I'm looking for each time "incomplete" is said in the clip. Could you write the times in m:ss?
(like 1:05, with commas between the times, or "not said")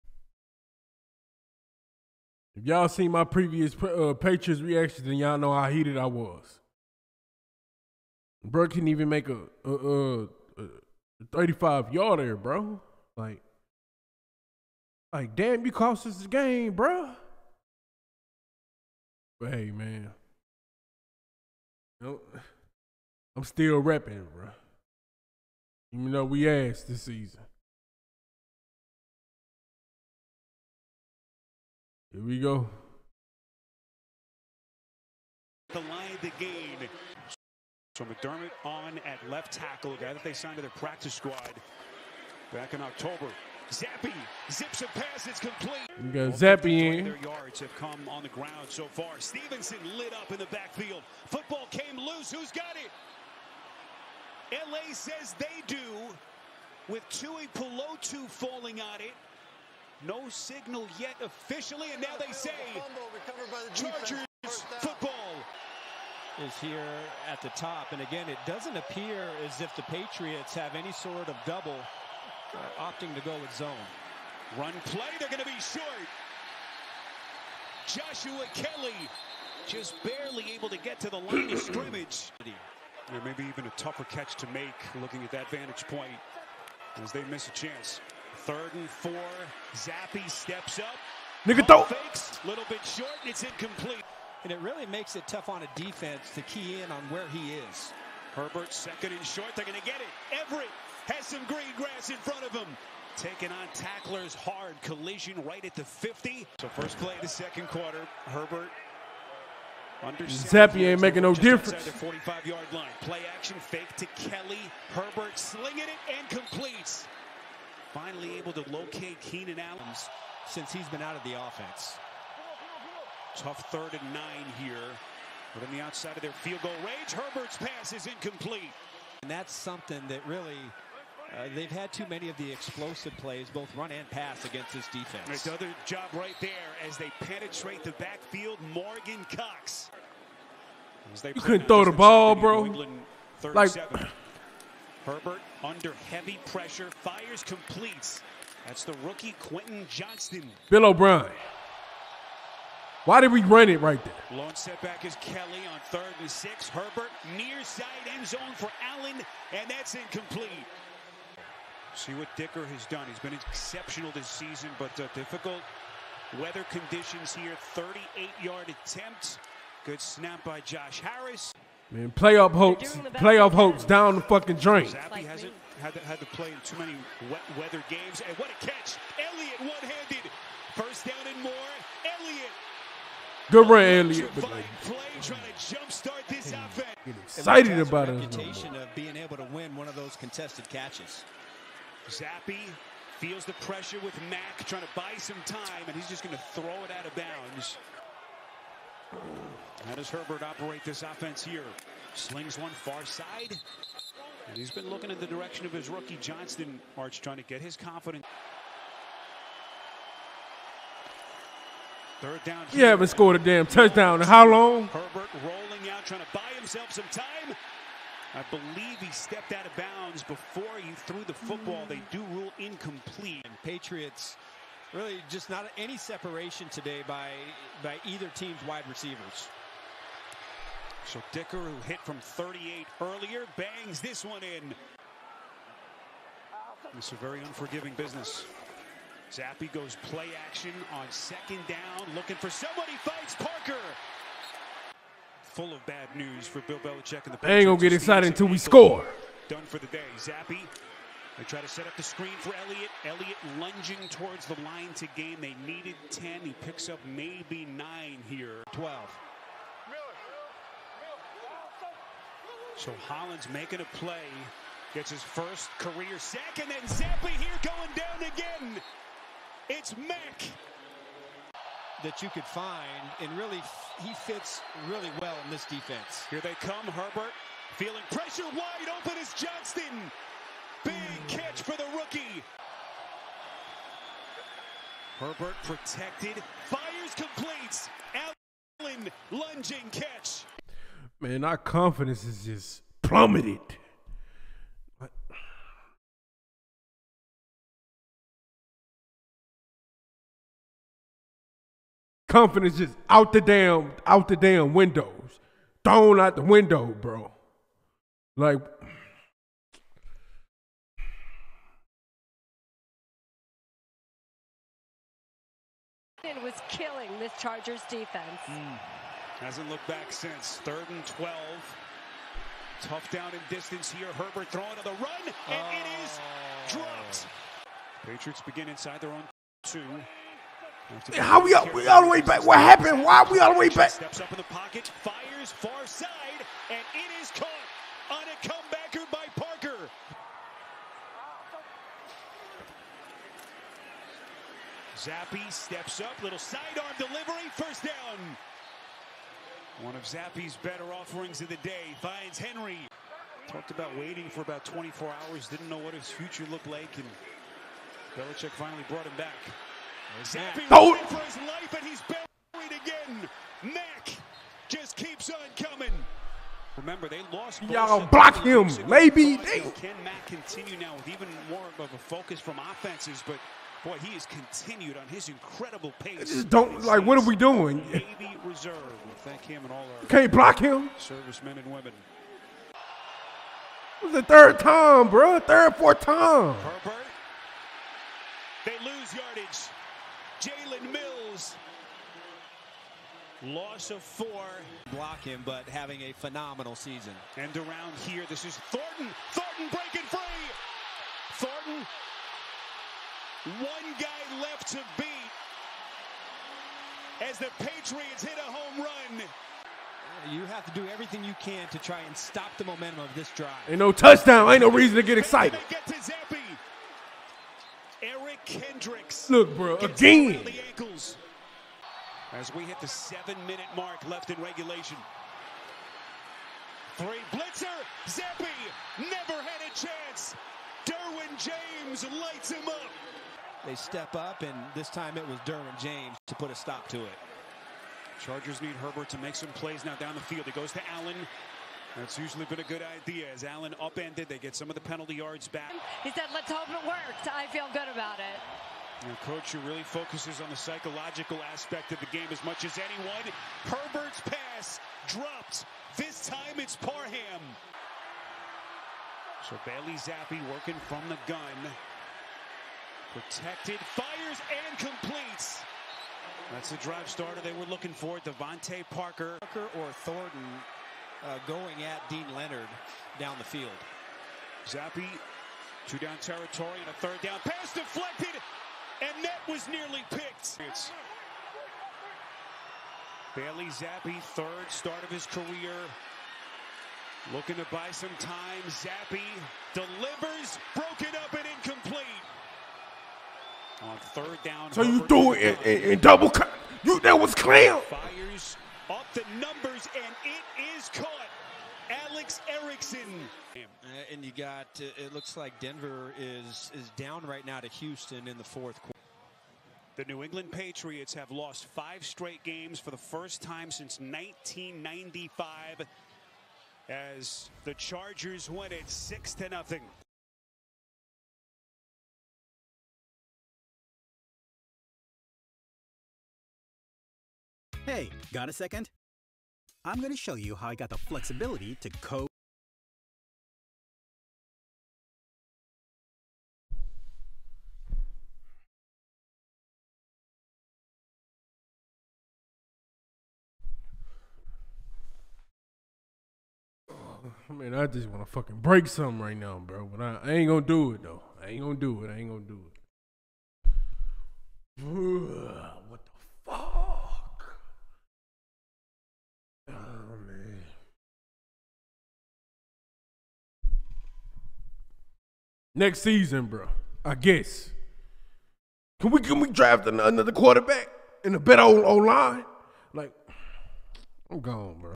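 1:33, 2:08, 2:39, 3:42, 8:11.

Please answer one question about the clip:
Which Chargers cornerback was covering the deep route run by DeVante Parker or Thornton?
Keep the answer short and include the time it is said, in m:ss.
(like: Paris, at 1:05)
Deane Leonard, at 7:52.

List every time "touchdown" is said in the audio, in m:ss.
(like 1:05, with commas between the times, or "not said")
3:33, 6:53.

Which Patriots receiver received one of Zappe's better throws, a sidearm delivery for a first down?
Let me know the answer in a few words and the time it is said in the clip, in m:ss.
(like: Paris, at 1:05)
Henry, at 5:52.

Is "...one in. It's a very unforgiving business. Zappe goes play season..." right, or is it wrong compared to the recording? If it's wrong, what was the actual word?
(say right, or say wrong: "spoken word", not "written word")
wrong: "action", not "season".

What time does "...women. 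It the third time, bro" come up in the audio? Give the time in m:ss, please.
6:21.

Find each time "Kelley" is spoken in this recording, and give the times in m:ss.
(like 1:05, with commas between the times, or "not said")
1:18, 1:54, 2:35.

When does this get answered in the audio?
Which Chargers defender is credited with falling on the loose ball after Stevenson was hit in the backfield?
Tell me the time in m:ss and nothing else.
0:57.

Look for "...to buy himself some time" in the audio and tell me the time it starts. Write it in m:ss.
3:36.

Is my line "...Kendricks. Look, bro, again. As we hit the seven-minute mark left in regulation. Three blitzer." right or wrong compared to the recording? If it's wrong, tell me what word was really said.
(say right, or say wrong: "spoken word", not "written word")
right.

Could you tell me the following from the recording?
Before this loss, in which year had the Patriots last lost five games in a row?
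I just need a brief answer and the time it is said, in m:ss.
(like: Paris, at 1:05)
1995, at 8:33.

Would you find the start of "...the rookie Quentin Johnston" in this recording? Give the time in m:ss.
2:28.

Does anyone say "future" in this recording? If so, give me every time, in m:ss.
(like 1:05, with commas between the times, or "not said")
5:56.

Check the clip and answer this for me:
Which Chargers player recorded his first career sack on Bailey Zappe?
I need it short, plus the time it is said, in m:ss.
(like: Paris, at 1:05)
Hollins, at 4:23.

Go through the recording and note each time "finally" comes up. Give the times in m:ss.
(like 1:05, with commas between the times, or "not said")
1:57, 5:58.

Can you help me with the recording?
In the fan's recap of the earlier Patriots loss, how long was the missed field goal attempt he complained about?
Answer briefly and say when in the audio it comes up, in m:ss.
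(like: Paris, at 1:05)
35 yards, at 0:11.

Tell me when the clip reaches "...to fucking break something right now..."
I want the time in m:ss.
9:08.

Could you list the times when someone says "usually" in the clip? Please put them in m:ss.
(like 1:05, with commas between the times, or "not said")
7:22.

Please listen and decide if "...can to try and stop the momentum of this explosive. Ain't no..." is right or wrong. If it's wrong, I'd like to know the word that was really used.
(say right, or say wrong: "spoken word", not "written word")
wrong: "drive", not "explosive".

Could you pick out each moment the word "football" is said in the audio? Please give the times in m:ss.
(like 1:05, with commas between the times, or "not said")
0:51, 1:04, 3:41.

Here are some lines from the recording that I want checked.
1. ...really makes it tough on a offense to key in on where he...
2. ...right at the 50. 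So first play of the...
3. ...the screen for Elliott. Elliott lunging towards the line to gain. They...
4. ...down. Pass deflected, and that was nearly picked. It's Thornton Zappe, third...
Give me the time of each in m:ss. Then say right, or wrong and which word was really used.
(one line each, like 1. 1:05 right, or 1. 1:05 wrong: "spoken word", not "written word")
1. 1:34 wrong: "defense", not "offense"
2. 1:45 right
3. 4:11 right
4. 7:57 wrong: "Bailey", not "Thornton".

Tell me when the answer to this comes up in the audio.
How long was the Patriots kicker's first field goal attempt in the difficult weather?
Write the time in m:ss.
2:47.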